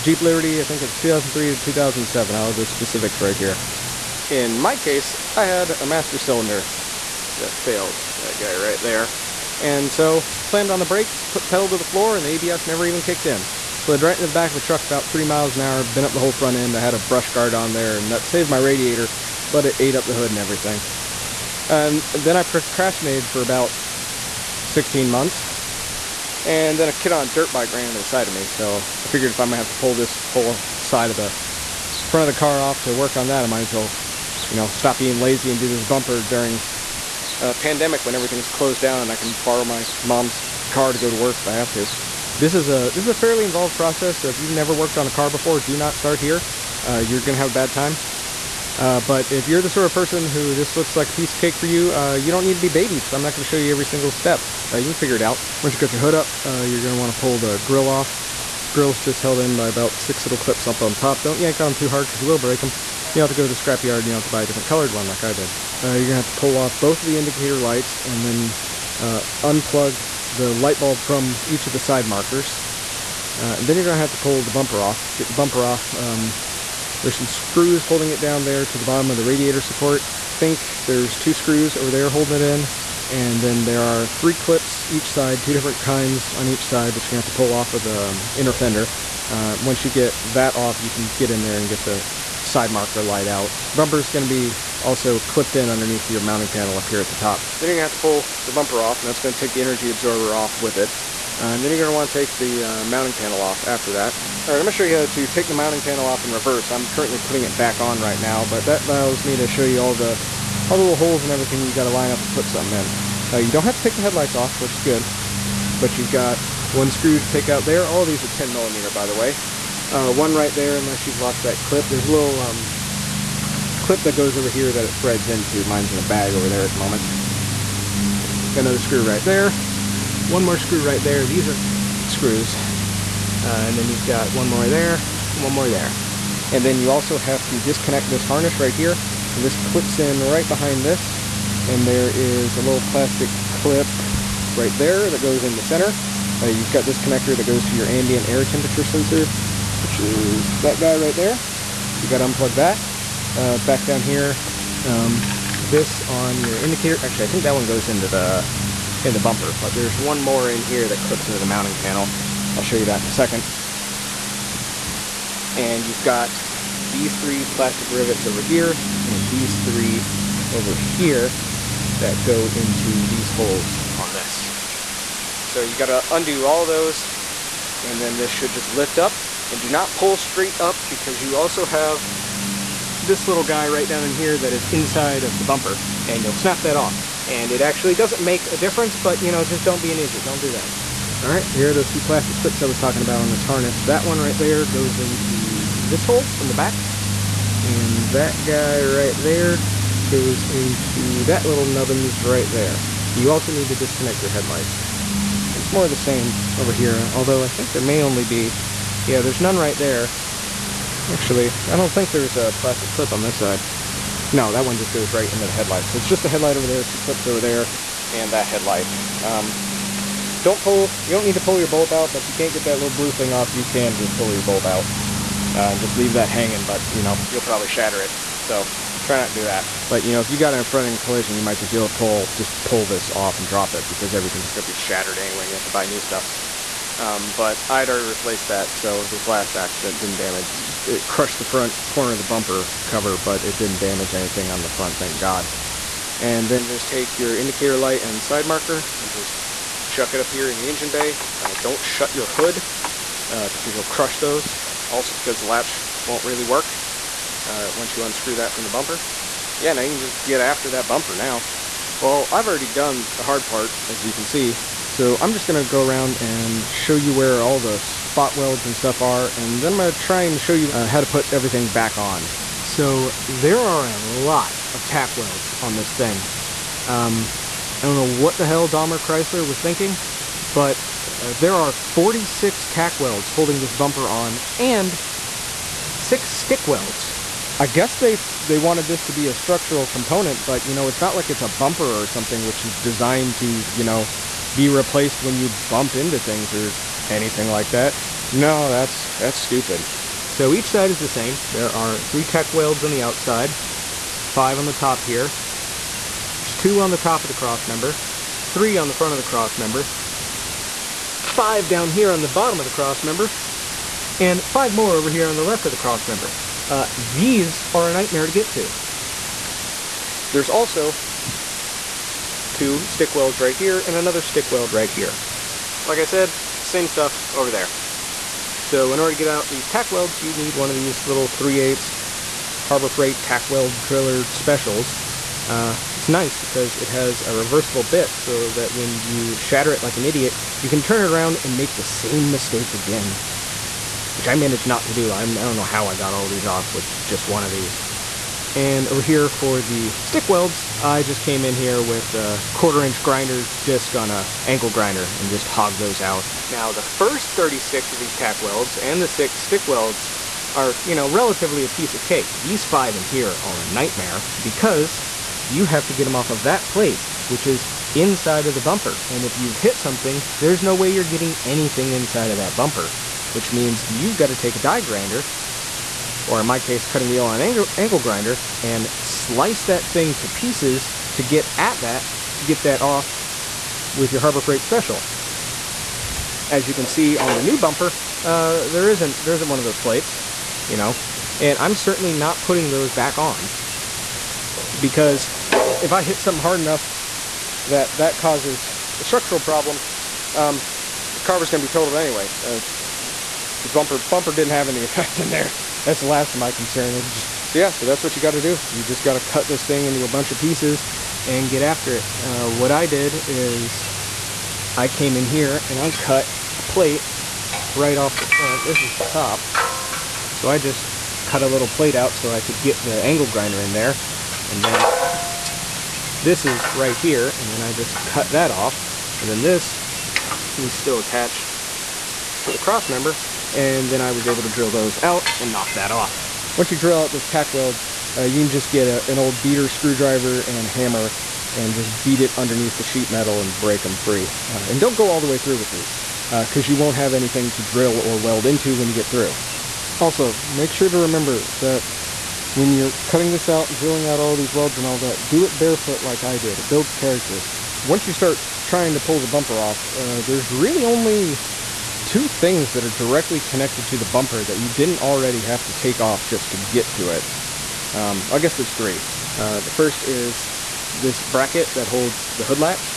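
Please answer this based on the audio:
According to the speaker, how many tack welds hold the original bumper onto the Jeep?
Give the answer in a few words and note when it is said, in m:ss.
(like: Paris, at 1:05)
46, at 4:41.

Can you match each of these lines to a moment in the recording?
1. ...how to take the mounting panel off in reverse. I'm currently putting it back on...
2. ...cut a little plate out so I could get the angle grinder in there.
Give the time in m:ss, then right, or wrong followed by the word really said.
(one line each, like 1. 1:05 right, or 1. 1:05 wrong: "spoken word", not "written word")
1. 1:44 right
2. 7:01 right.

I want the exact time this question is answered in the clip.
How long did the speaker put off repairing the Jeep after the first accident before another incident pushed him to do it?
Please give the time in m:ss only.
0:24.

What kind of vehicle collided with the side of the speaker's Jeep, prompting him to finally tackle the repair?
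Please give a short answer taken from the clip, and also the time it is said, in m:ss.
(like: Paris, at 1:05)
A dirt bike, at 0:27.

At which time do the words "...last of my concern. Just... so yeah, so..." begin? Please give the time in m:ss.
6:46.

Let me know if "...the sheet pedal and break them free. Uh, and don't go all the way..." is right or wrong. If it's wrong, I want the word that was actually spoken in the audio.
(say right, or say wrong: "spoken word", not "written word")
wrong: "metal", not "pedal".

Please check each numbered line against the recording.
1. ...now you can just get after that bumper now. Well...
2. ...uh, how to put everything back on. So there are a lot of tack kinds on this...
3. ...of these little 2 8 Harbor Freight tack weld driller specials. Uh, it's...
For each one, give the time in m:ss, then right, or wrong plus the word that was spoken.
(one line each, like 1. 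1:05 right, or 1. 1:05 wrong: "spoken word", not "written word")
1. 4:19 right
2. 4:30 wrong: "welds", not "kinds"
3. 5:30 wrong: "3", not "2".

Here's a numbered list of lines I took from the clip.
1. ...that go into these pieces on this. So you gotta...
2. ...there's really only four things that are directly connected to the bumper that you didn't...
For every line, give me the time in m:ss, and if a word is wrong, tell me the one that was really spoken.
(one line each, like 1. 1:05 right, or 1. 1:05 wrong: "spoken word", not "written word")
1. 2:51 wrong: "holes", not "pieces"
2. 7:40 wrong: "two", not "four".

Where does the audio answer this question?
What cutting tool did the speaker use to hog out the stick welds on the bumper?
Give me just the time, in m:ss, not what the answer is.
5:52.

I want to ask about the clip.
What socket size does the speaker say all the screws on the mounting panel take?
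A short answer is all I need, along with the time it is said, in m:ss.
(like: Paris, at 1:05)
10 millimeter, at 1:58.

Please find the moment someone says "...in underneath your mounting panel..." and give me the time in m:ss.
1:35.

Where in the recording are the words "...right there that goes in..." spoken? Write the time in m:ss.
2:24.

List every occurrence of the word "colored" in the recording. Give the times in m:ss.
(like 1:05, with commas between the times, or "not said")
1:04.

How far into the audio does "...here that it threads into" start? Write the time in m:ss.
2:04.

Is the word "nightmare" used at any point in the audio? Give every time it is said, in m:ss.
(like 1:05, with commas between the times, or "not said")
5:17, 6:03.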